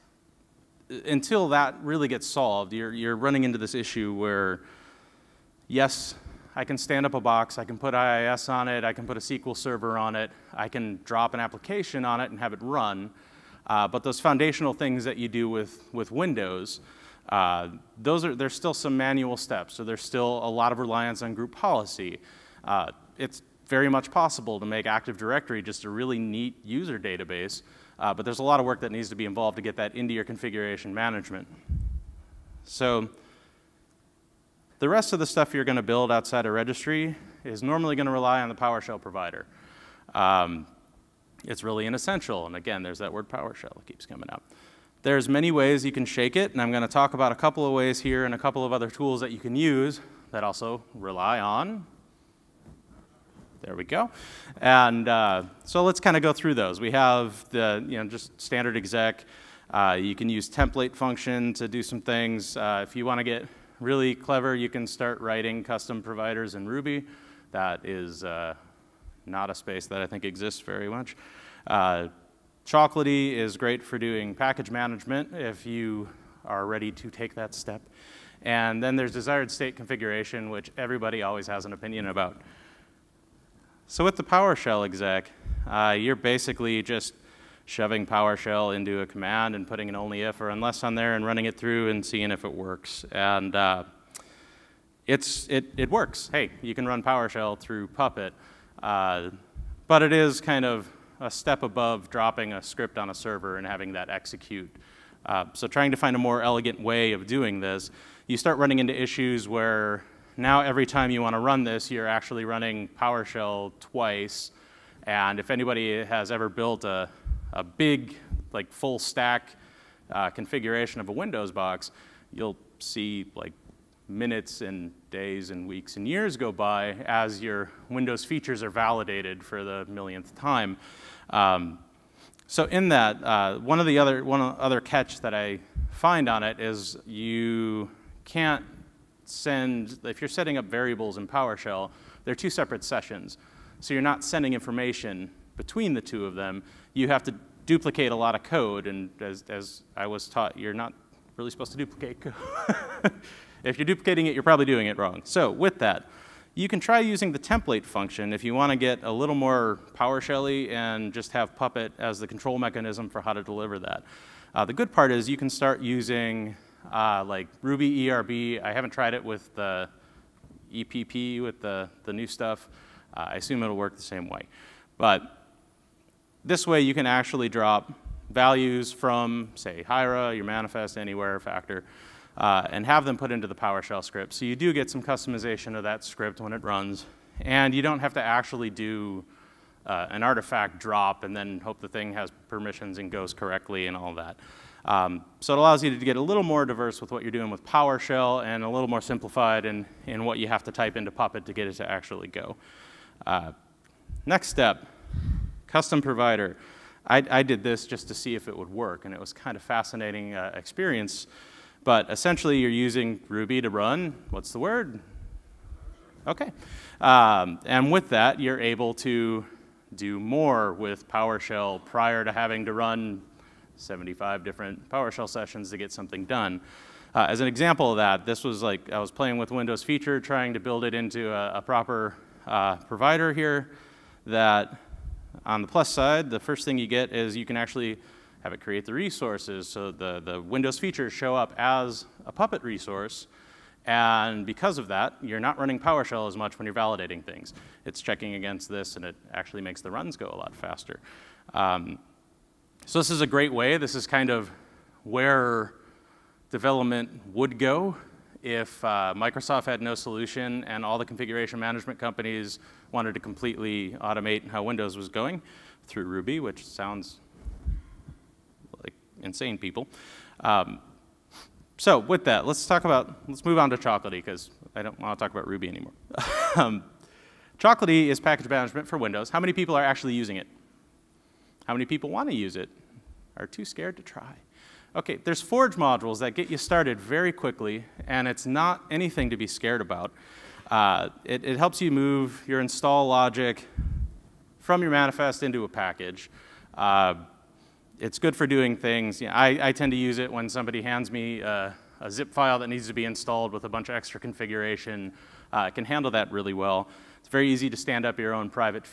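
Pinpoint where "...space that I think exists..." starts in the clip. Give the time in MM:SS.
01:09.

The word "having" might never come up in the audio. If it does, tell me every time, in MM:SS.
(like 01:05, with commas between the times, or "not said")
01:43, 03:42.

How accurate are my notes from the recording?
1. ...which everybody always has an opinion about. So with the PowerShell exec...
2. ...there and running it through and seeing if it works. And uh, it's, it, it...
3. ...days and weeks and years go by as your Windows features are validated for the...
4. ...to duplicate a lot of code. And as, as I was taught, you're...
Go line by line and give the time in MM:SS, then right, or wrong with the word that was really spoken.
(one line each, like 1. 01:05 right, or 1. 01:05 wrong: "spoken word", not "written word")
1. 01:20 right
2. 01:30 right
3. 02:05 right
4. 02:27 right.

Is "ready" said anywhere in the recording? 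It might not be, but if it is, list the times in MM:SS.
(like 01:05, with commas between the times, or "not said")
01:16.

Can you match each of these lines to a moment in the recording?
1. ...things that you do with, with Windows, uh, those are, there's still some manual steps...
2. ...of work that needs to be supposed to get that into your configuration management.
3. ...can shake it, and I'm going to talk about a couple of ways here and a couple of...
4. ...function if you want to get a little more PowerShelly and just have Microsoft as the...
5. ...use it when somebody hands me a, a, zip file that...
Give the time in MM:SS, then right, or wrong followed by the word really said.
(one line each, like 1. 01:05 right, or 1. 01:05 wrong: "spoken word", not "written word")
1. 00:14 right
2. 00:28 wrong: "involved", not "supposed"
3. 00:45 right
4. 02:37 wrong: "Puppet", not "Microsoft"
5. 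04:59 right.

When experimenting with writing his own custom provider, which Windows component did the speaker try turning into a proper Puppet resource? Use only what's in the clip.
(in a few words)
Windows Feature.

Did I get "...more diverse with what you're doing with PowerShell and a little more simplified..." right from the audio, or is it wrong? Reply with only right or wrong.
right.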